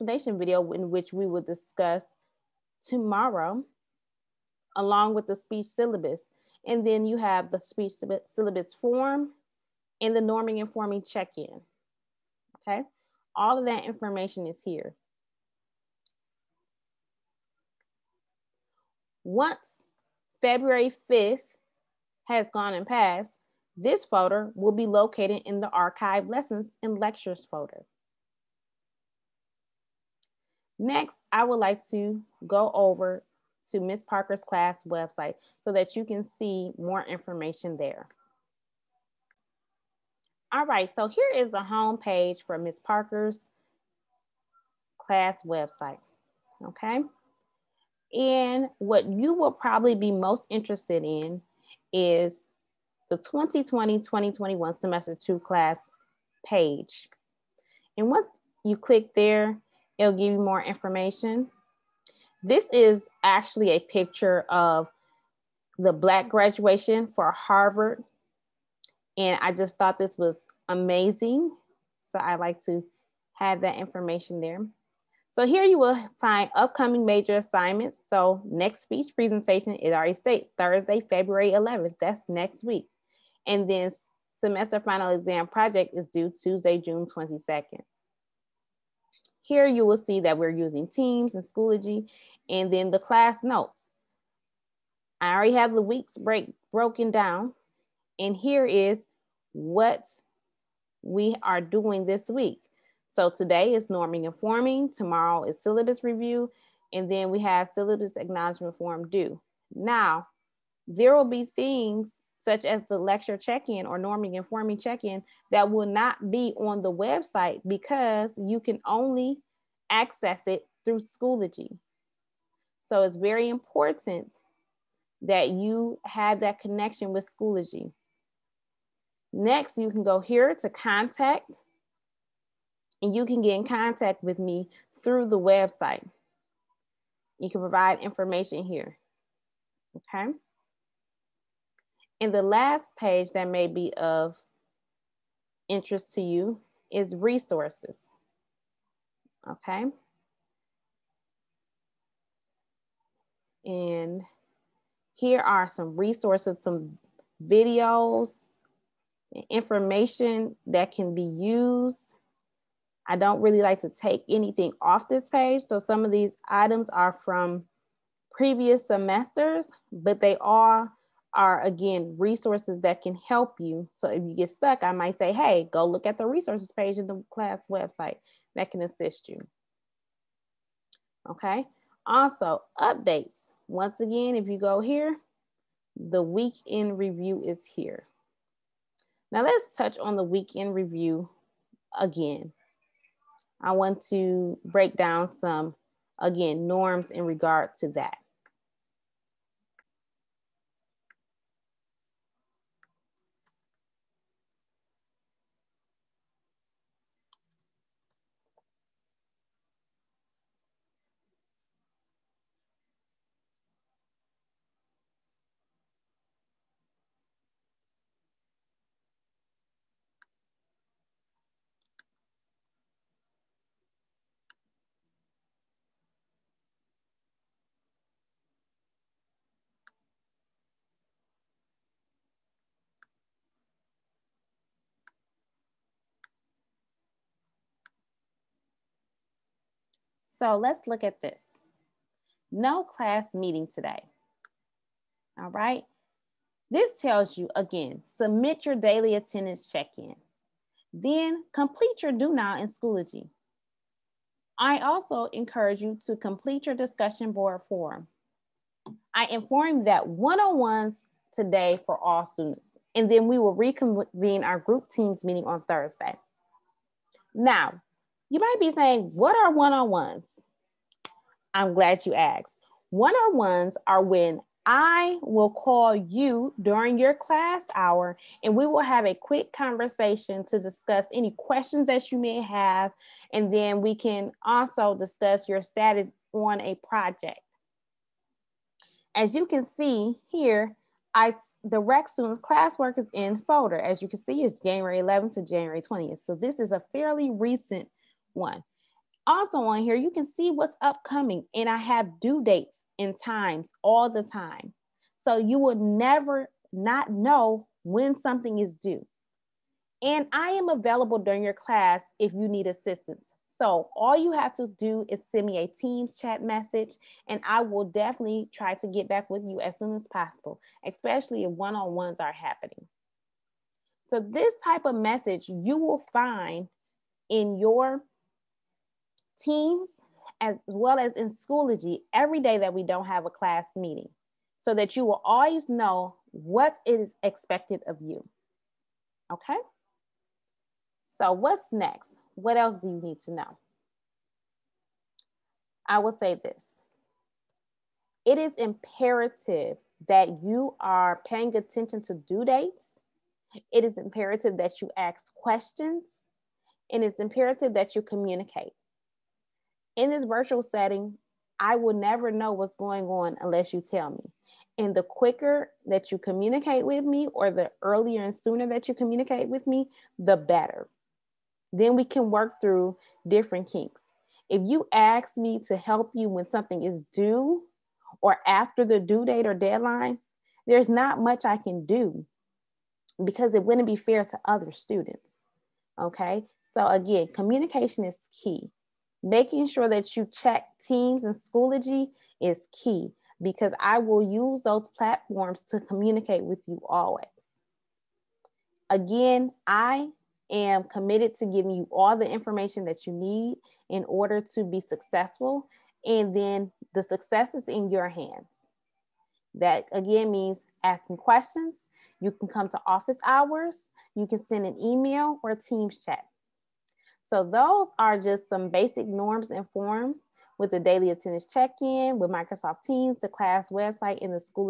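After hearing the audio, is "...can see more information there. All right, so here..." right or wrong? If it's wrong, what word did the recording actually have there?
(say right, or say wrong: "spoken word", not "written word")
right.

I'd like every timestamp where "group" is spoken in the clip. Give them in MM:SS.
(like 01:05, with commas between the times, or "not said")
04:24.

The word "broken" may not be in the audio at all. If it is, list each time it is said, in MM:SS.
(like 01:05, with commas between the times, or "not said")
01:36.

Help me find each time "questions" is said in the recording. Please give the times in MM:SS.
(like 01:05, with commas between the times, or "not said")
04:41, 05:55, 06:51.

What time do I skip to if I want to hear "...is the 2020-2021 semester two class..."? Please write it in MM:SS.
00:51.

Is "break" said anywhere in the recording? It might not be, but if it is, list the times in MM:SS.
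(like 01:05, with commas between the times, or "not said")
01:36, 03:14.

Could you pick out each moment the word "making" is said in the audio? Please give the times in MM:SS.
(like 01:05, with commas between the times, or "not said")
06:29.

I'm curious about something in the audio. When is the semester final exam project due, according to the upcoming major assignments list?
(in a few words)
Tuesday, June 22nd.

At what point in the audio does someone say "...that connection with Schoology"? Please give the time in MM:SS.
02:06.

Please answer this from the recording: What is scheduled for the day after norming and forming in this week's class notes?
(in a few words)
syllabus review.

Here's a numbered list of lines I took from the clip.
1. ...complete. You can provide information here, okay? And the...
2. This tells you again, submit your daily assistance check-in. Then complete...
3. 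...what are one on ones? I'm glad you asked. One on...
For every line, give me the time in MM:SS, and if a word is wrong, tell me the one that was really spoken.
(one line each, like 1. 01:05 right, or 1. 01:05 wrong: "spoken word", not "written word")
1. 02:15 wrong: "website", not "complete"
2. 04:06 wrong: "attendance", not "assistance"
3. 04:29 right.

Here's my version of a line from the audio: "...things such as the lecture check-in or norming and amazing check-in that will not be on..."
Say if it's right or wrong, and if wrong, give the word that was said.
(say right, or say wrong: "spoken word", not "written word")
wrong: "forming", not "amazing".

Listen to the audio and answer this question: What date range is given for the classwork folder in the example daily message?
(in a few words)
January 11 to January 20.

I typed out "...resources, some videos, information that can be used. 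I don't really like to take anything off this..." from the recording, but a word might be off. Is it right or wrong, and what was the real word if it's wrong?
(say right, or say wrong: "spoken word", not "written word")
right.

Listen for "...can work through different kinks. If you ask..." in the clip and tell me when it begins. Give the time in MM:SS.
06:12.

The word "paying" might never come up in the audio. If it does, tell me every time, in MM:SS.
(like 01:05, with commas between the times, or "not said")
05:51.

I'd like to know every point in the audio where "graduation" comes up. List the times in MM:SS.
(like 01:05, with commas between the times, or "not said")
01:06.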